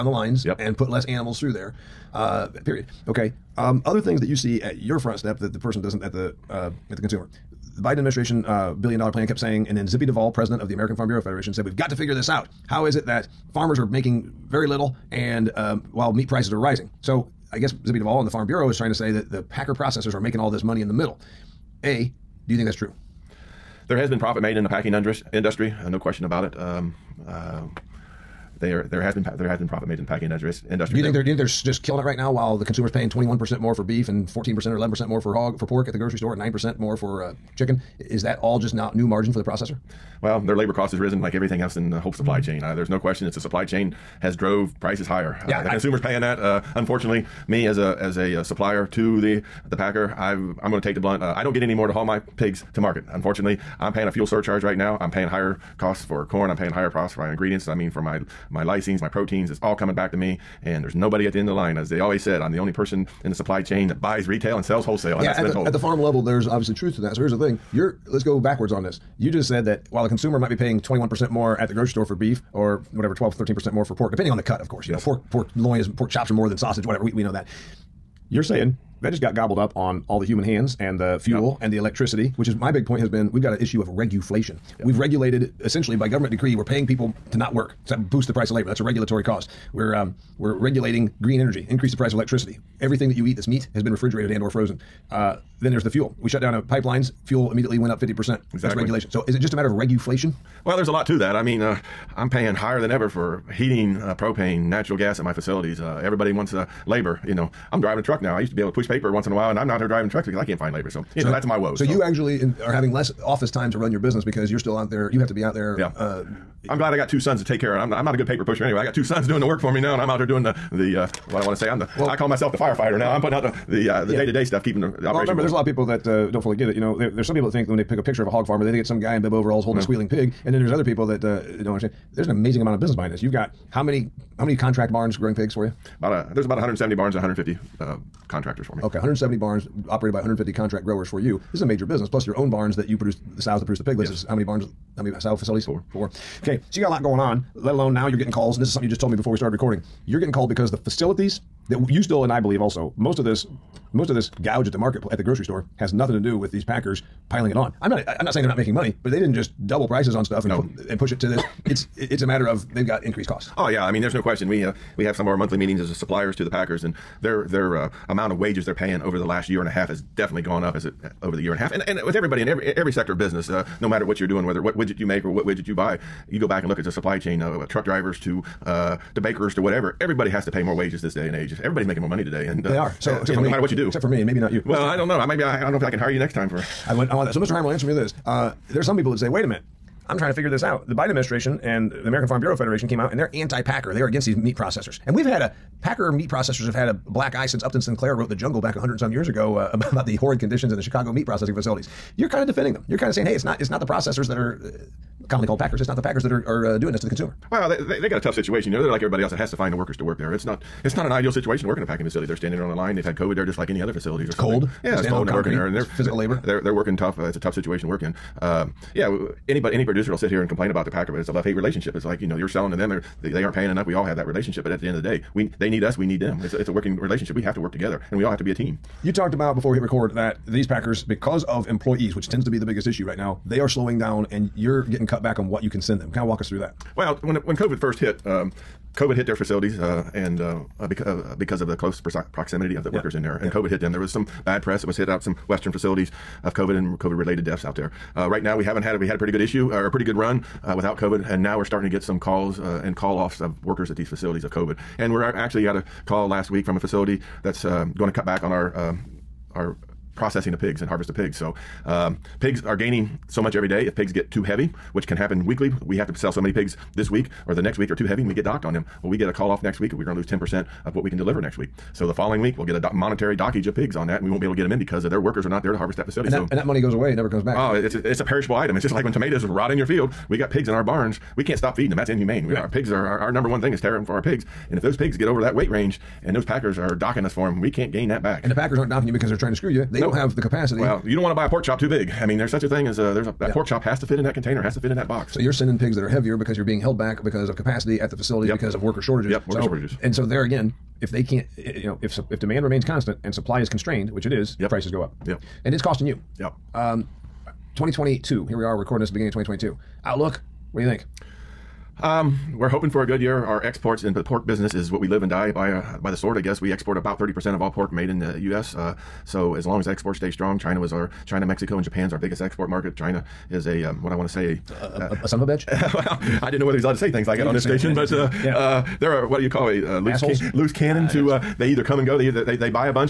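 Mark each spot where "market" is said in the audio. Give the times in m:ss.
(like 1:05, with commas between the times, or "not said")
0:52, 2:34, 5:22.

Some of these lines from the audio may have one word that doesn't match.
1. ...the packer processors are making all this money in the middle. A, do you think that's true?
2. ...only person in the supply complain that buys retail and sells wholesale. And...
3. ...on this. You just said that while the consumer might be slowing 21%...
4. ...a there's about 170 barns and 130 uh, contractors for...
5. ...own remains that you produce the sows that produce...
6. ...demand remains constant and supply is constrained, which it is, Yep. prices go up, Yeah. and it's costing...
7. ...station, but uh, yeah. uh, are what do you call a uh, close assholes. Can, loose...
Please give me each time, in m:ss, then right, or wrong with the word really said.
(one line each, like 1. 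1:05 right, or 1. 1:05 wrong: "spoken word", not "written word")
1. 0:19 right
2. 1:02 wrong: "chain", not "complain"
3. 1:08 wrong: "paying", not "slowing"
4. 2:16 wrong: "150", not "130"
5. 2:22 wrong: "barns", not "remains"
6. 5:02 right
7. 5:27 wrong: "loose", not "close".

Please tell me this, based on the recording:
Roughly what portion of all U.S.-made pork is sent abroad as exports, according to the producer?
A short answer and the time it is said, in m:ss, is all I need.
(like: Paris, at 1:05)
30%, at 5:17.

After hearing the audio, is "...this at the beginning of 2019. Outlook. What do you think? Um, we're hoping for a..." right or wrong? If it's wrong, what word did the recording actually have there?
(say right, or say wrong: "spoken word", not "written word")
wrong: "2022", not "2019".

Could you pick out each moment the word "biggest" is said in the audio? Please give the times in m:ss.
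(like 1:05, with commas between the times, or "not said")
3:52, 5:22.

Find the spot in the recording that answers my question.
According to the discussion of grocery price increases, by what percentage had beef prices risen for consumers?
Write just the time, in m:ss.
0:33.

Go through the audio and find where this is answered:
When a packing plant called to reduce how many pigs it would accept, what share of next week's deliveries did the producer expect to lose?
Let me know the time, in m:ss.
4:30.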